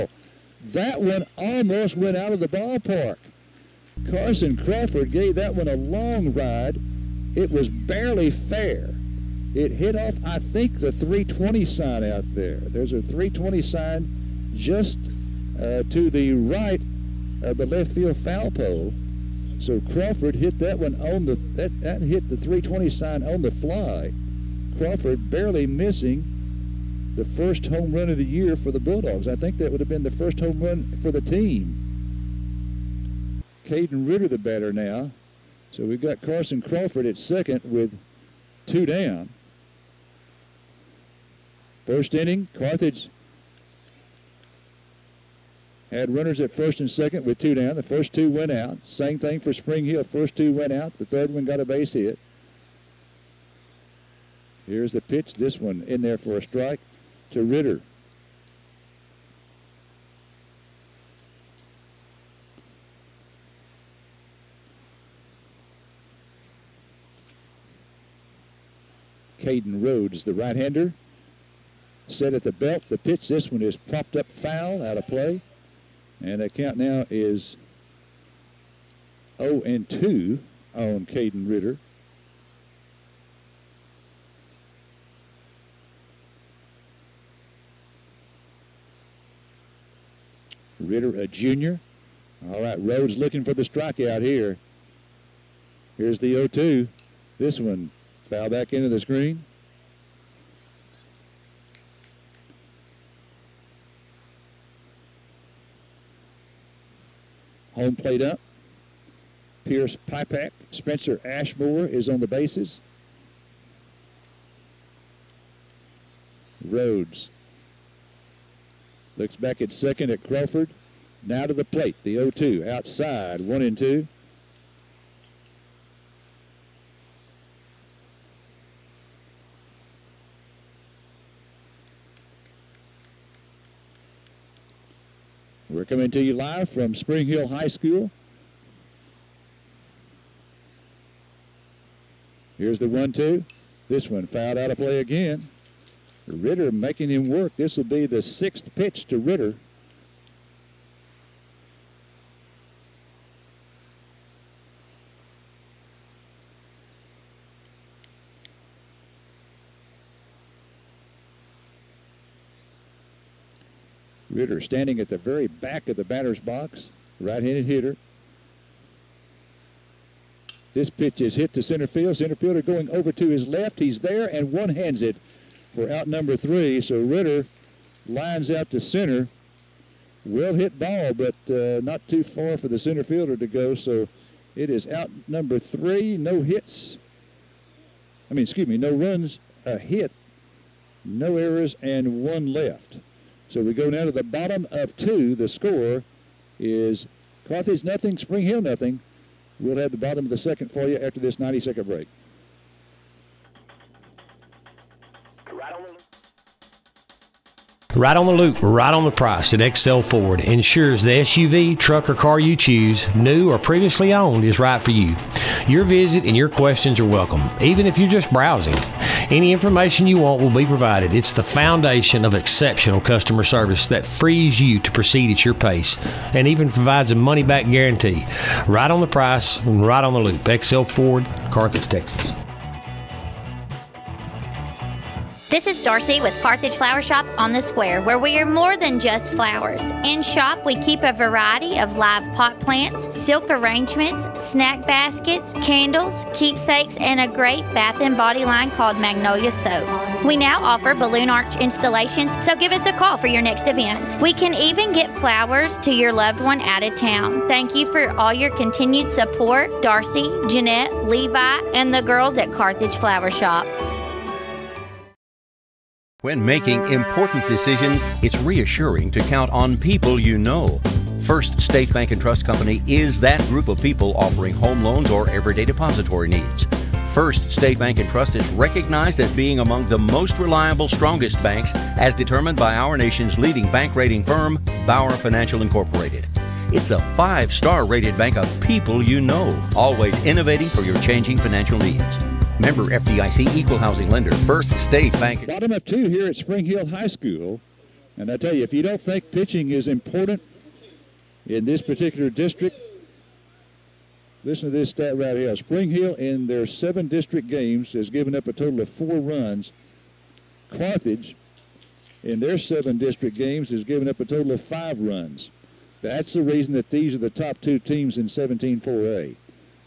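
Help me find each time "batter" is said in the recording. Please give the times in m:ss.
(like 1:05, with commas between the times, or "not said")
0:34, 2:46.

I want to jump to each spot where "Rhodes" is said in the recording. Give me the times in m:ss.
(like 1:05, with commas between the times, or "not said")
1:09, 1:32, 1:56.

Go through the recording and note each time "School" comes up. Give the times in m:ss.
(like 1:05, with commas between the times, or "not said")
2:17, 4:57.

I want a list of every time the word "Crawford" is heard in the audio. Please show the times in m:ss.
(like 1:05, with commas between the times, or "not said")
0:04, 0:19, 0:24, 0:36, 2:00.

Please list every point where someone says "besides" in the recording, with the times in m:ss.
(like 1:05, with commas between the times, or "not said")
not said.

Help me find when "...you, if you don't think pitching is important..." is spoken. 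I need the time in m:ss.
4:58.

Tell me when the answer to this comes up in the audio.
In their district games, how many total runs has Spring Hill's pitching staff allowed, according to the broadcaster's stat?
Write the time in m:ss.
5:08.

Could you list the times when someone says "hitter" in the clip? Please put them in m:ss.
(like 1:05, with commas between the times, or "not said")
2:47.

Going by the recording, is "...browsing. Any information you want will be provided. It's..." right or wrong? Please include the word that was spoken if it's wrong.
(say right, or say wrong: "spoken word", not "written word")
right.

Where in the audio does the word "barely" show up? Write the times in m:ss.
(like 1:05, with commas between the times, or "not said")
0:07, 0:25.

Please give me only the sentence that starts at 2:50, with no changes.
This pitch is hit to center field.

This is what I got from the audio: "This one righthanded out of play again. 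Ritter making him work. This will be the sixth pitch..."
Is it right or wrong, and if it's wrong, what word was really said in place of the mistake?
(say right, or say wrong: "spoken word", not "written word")
wrong: "fouled", not "righthanded".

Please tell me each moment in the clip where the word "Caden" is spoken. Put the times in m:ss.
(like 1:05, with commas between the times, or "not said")
0:33, 1:09, 1:21.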